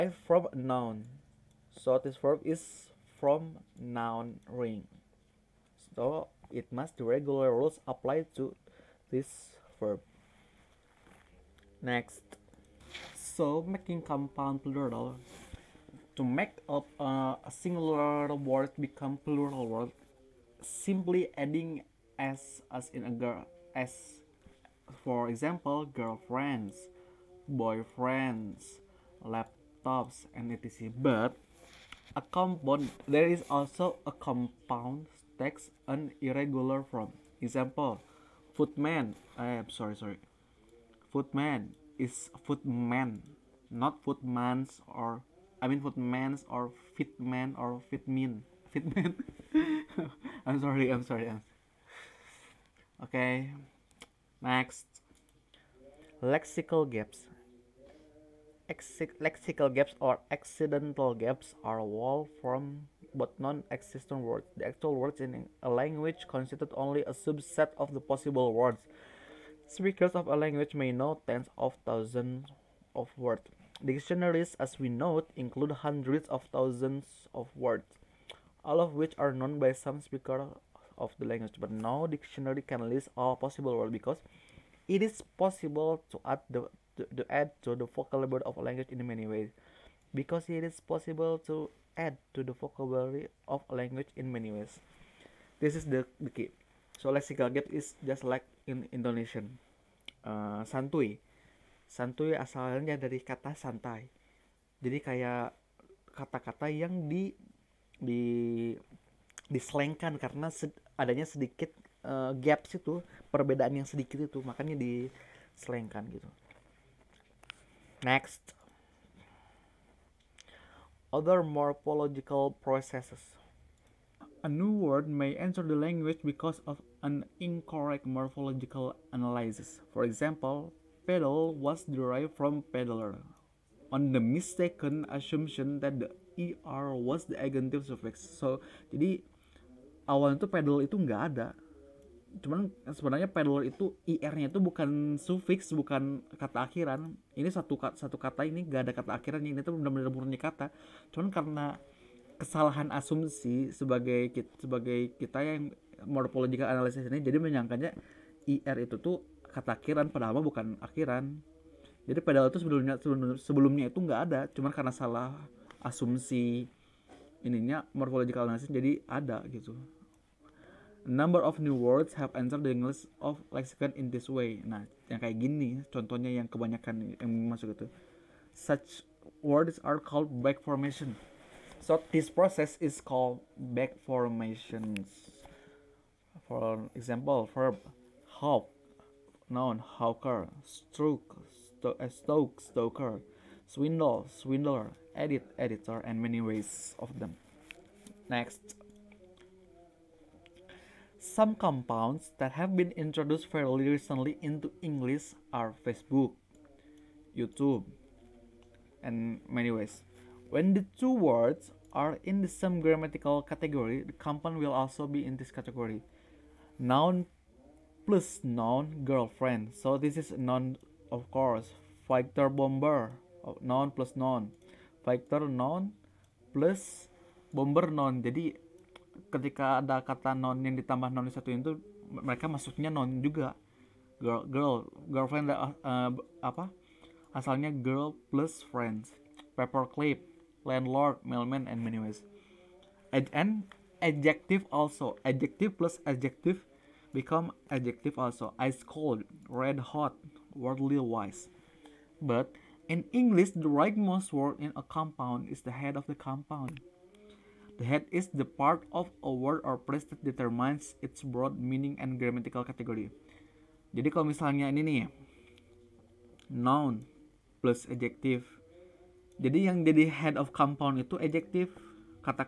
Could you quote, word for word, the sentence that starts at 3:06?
For example, verb hawk, noun hawker, stroke, sto uh, stoke, stoker, swindle, swindler, edit, editor, and many ways of them.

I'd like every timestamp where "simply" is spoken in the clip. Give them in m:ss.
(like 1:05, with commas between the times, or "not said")
0:20.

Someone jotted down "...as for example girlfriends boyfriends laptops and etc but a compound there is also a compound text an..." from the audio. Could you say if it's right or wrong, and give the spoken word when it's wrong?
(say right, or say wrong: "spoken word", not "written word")
right.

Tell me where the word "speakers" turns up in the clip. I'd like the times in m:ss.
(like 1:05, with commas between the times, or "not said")
1:09, 1:20.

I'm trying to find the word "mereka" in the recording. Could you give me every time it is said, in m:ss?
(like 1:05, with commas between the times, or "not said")
3:52.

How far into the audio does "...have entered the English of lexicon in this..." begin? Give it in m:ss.
2:52.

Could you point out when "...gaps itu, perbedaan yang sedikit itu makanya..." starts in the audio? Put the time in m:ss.
1:52.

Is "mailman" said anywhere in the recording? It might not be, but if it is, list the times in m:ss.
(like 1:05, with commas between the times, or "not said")
4:01.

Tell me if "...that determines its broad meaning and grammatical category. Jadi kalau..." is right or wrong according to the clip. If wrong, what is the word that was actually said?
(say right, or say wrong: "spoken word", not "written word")
right.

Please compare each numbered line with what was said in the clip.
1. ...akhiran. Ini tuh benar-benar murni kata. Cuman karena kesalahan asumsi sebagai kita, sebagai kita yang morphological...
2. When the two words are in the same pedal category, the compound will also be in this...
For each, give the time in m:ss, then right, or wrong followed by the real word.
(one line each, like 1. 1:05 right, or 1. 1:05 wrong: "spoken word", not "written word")
1. 2:29 right
2. 3:30 wrong: "grammatical", not "pedal".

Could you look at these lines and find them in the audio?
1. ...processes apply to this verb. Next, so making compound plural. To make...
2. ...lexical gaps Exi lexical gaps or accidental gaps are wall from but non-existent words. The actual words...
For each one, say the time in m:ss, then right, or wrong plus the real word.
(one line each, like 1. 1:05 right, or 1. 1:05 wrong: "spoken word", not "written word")
1. 0:07 wrong: "rules", not "processes"
2. 0:56 right.